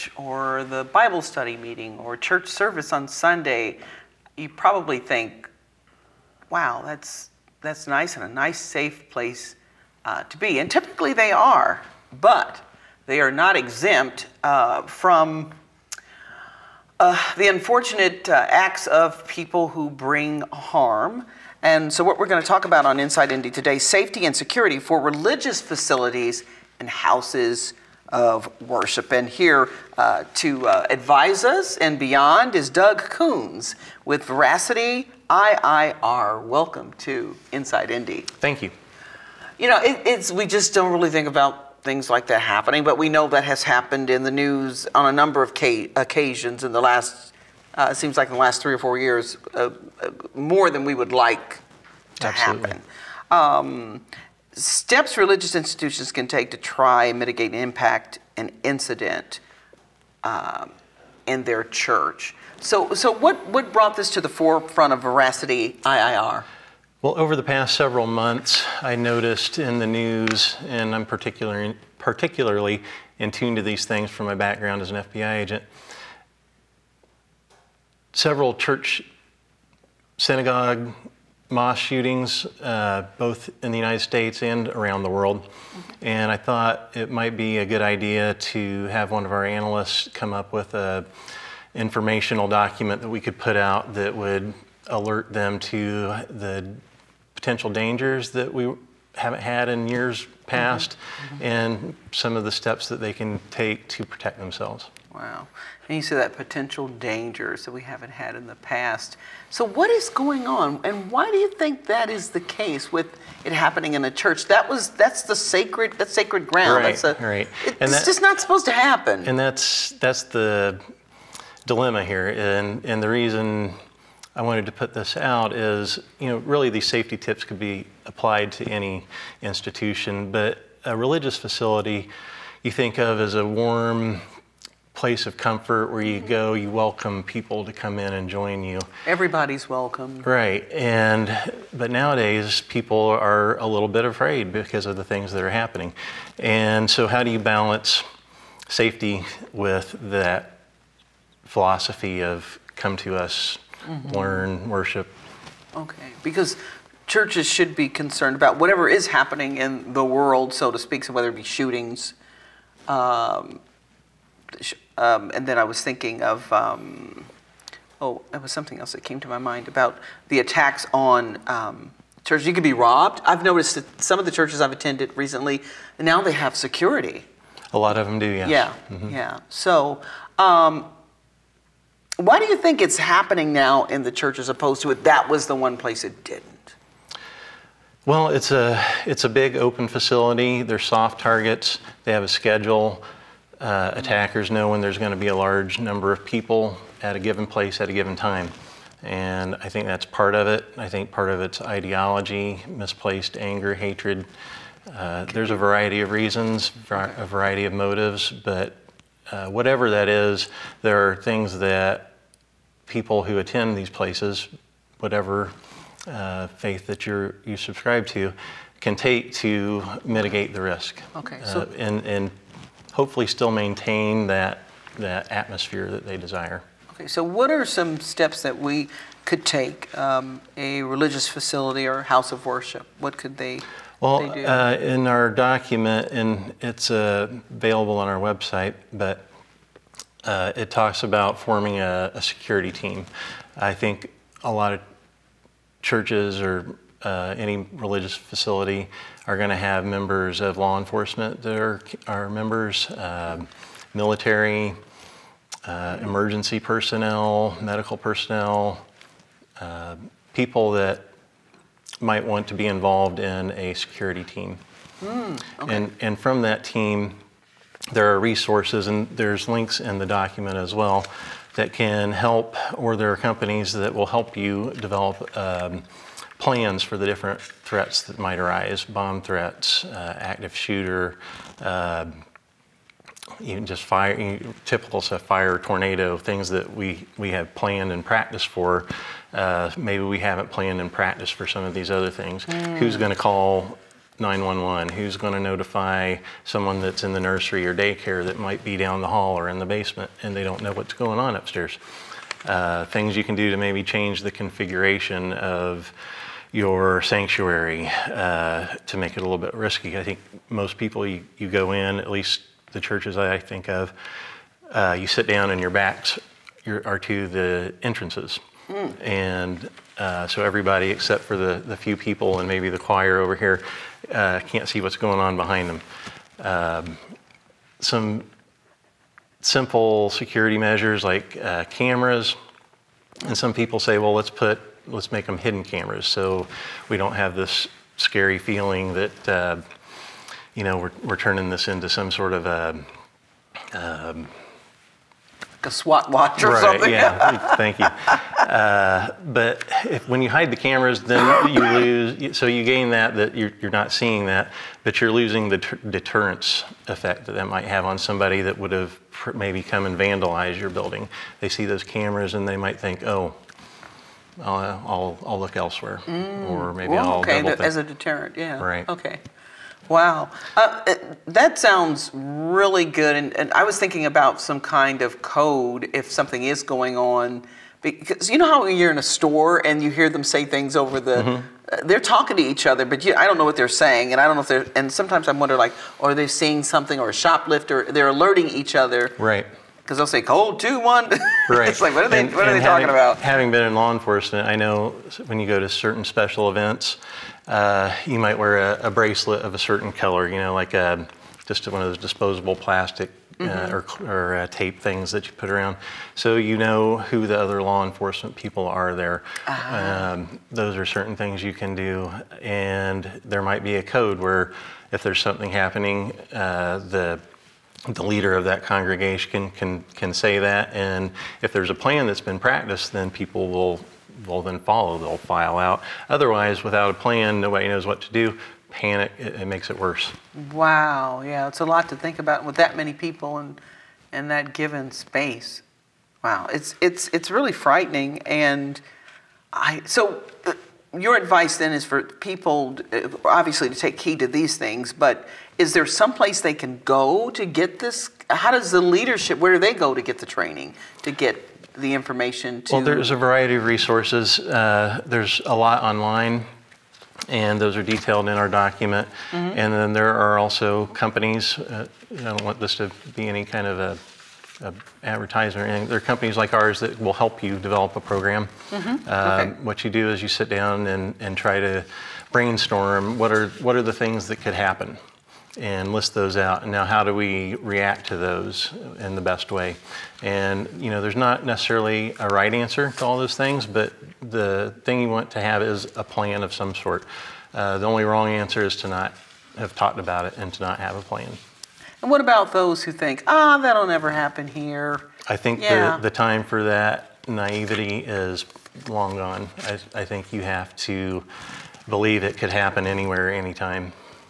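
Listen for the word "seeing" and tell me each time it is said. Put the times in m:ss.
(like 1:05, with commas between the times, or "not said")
5:53, 6:26.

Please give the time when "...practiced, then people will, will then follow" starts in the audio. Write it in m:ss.
7:02.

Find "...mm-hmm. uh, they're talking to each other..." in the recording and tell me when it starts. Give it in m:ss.
6:21.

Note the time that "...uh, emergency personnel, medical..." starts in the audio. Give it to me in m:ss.
4:15.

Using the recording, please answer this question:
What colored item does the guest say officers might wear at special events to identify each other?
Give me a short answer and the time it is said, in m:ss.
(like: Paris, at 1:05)
bracelet, at 6:38.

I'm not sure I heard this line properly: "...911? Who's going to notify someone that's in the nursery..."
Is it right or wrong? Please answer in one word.
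right.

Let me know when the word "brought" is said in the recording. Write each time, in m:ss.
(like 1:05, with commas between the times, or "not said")
1:03.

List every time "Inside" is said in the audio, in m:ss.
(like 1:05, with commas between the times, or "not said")
0:22, 0:37.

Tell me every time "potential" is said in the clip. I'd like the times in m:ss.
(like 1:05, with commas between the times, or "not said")
1:37, 1:46.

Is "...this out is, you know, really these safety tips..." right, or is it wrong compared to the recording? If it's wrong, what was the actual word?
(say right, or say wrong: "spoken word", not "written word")
right.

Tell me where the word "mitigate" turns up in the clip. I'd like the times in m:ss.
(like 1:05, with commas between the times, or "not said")
0:57, 3:40.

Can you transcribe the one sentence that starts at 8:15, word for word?
the, the time for that naivety is long gone.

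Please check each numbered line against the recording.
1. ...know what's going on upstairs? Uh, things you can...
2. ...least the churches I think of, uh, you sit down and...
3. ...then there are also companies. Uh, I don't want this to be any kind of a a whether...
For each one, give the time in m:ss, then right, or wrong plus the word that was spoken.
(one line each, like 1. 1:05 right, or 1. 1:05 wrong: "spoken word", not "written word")
1. 5:00 right
2. 5:12 right
3. 7:39 wrong: "advertiser", not "whether".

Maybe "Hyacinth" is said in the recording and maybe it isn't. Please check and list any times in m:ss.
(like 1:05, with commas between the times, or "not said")
not said.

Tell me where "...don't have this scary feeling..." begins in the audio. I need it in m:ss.
5:36.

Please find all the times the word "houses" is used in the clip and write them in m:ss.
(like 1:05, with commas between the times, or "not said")
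0:26, 3:52.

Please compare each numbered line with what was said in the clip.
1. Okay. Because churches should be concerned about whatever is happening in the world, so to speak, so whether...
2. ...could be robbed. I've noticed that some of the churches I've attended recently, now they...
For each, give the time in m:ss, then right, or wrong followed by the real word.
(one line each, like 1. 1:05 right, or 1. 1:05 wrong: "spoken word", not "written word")
1. 2:35 right
2. 2:52 right.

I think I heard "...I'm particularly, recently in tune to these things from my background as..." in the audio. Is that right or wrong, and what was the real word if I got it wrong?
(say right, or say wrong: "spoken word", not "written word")
wrong: "particularly", not "recently".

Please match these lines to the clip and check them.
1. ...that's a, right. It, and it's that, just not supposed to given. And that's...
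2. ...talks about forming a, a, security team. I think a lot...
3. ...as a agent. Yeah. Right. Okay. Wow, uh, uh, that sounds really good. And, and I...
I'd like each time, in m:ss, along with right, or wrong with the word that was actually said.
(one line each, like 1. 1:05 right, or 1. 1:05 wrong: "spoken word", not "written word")
1. 1:56 wrong: "happen", not "given"
2. 4:00 right
3. 6:07 wrong: "deterrent", not "agent".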